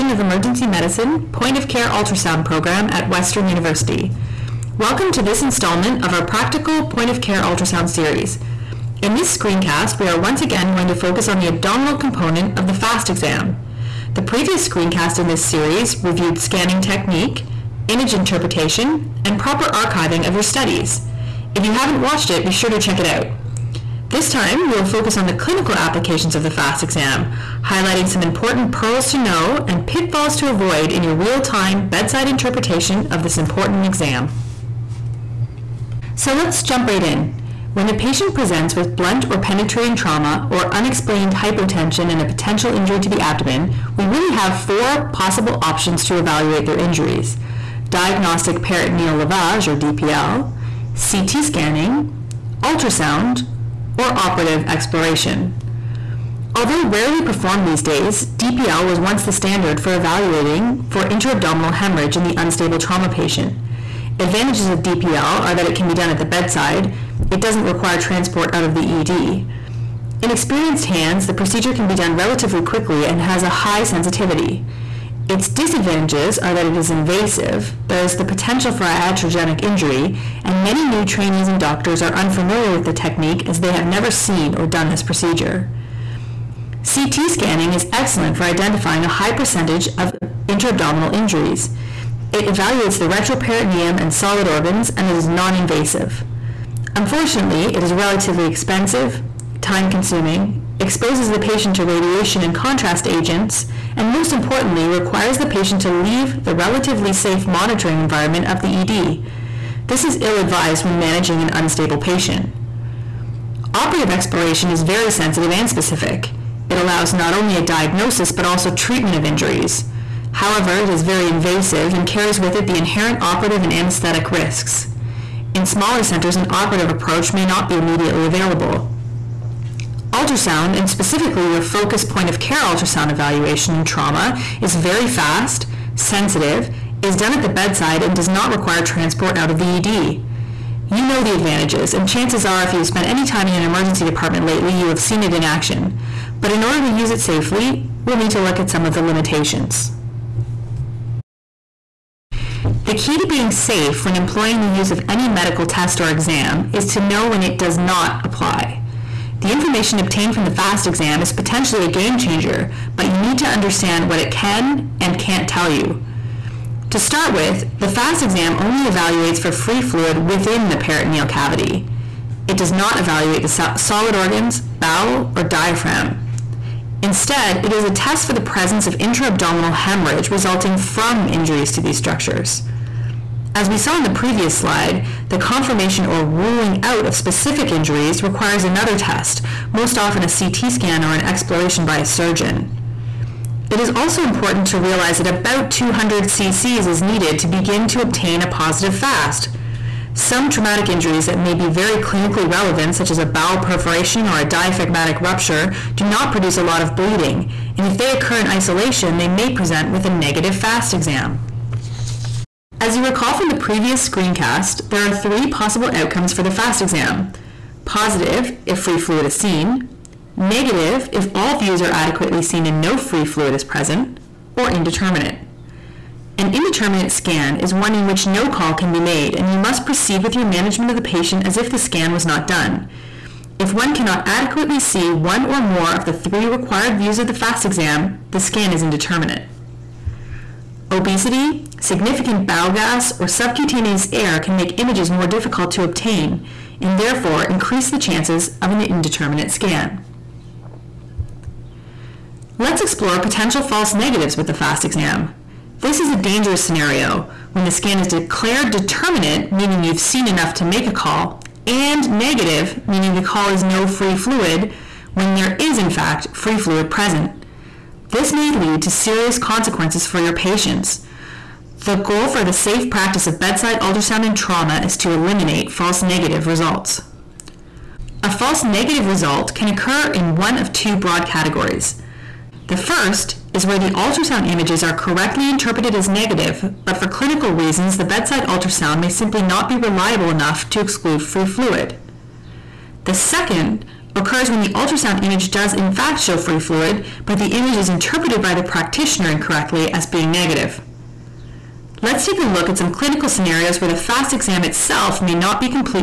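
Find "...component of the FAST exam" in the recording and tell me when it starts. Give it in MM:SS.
00:11.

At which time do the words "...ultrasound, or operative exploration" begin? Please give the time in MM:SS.
00:52.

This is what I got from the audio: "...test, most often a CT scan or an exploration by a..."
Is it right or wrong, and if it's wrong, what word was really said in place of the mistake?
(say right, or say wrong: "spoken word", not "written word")
right.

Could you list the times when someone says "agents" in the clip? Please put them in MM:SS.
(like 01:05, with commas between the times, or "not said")
01:43.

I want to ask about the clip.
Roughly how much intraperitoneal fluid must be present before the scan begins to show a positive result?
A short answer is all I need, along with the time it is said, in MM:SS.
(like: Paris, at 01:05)
200 cc, at 03:15.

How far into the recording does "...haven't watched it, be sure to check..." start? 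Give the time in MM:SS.
00:21.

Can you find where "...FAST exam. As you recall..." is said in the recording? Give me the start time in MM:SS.
03:30.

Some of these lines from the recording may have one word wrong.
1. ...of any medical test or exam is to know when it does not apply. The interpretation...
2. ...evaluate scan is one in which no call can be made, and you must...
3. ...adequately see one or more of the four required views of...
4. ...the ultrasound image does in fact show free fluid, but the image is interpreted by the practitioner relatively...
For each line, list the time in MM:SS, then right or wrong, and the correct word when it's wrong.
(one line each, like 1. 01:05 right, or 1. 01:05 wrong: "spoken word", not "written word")
1. 02:34 wrong: "information", not "interpretation"
2. 03:46 wrong: "indeterminate", not "evaluate"
3. 03:54 wrong: "three", not "four"
4. 04:54 wrong: "incorrectly", not "relatively".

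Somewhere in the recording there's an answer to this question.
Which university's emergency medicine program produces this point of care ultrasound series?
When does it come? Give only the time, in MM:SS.
00:03.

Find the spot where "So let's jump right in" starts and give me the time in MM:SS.
00:36.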